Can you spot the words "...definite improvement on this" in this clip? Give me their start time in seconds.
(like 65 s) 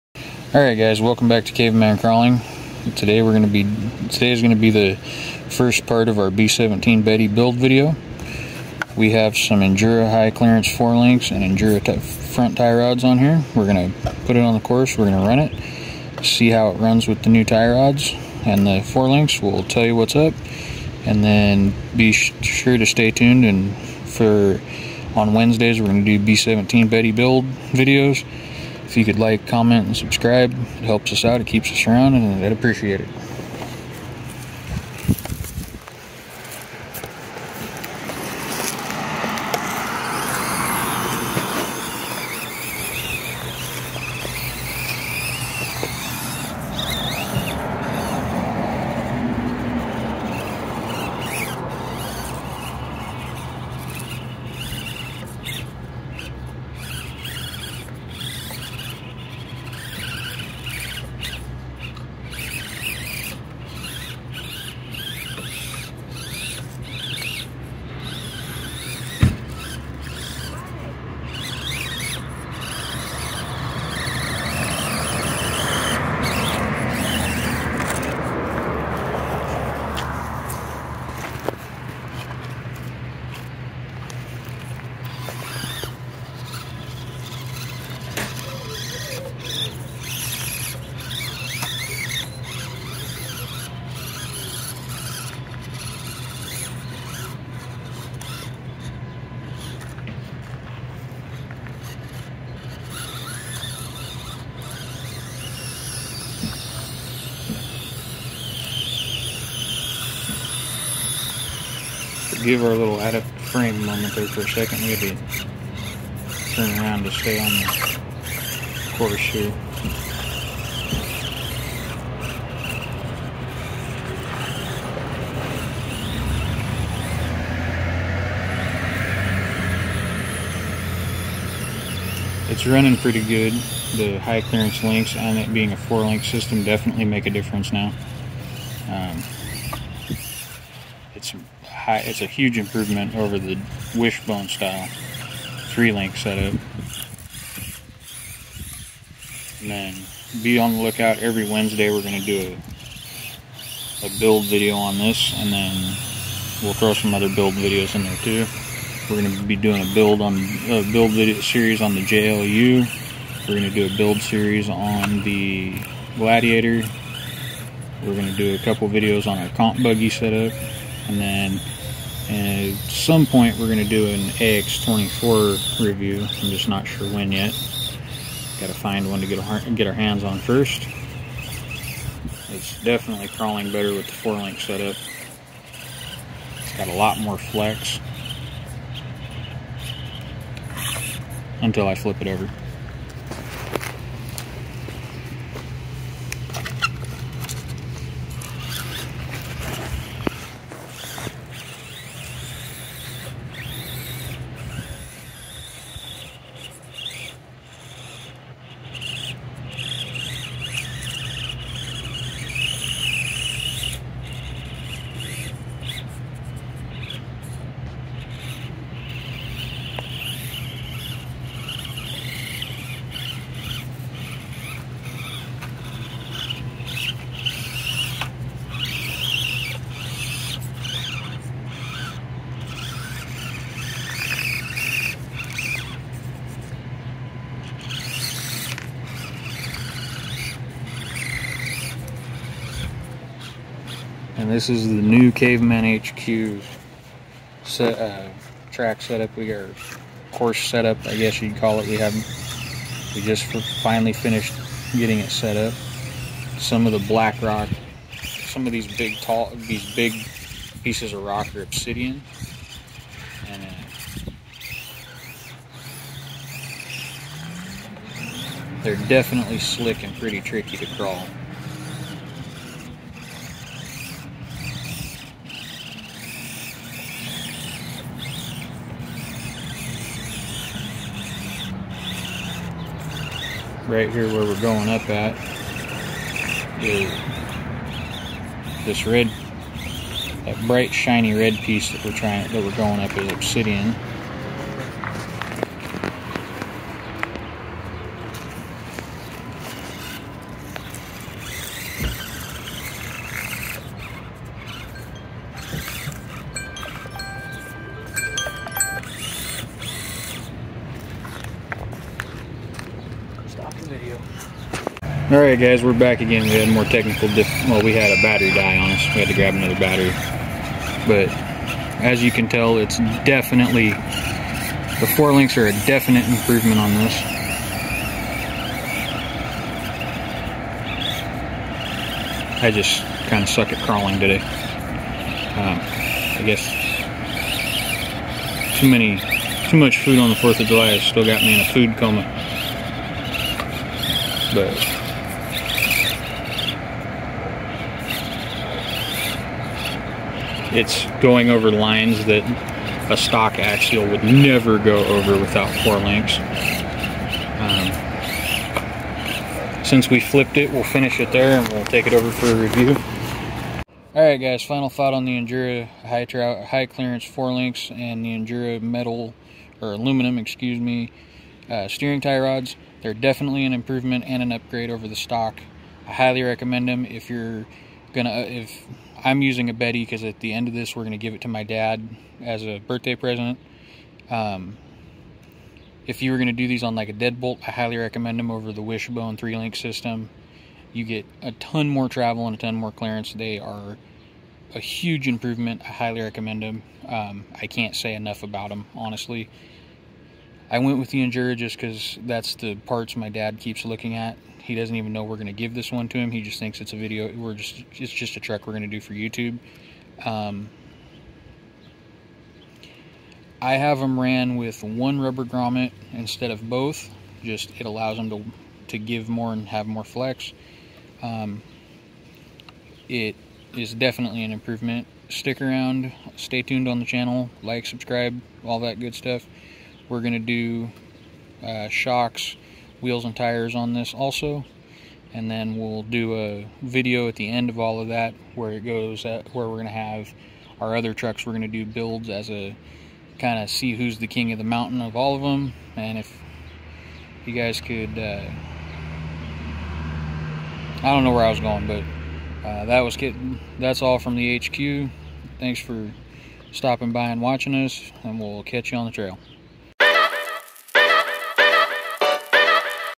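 325 s.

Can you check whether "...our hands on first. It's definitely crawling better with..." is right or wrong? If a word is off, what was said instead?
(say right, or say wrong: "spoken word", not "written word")
right.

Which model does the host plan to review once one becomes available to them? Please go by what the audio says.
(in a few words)
AX24.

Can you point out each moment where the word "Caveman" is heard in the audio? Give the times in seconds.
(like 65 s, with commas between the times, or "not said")
1 s, 245 s.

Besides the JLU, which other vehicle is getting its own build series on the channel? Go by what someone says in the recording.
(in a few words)
Gladiator.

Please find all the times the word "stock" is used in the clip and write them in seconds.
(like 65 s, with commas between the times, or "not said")
353 s, 375 s.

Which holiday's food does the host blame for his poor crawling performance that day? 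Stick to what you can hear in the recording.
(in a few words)
Fourth of July.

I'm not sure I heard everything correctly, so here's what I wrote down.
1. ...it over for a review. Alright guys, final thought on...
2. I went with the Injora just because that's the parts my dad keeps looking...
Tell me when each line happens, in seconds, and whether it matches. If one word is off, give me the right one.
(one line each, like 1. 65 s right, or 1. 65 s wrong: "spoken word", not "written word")
1. 362 s right
2. 400 s right.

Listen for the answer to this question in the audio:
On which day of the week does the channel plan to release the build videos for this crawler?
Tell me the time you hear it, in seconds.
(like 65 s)
25 s.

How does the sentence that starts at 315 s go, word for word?
All right, guys, we're back again.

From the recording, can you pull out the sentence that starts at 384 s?
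Um, if you were going to do these on like a deadbolt, I highly recommend them over the Wishbone three link system.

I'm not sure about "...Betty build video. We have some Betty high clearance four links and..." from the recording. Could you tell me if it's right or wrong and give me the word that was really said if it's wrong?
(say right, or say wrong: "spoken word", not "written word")
wrong: "Injora", not "Betty".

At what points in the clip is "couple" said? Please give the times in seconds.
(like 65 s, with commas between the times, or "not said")
168 s.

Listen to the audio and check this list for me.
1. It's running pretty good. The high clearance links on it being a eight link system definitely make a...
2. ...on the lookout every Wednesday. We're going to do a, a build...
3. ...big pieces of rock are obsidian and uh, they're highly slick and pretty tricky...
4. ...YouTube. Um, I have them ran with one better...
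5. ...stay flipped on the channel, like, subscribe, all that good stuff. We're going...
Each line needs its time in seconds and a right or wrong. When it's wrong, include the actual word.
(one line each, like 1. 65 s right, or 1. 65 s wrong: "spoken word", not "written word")
1. 132 s wrong: "four", not "eight"
2. 150 s right
3. 259 s wrong: "definitely", not "highly"
4. 409 s wrong: "rubber", not "better"
5. 426 s wrong: "tuned", not "flipped".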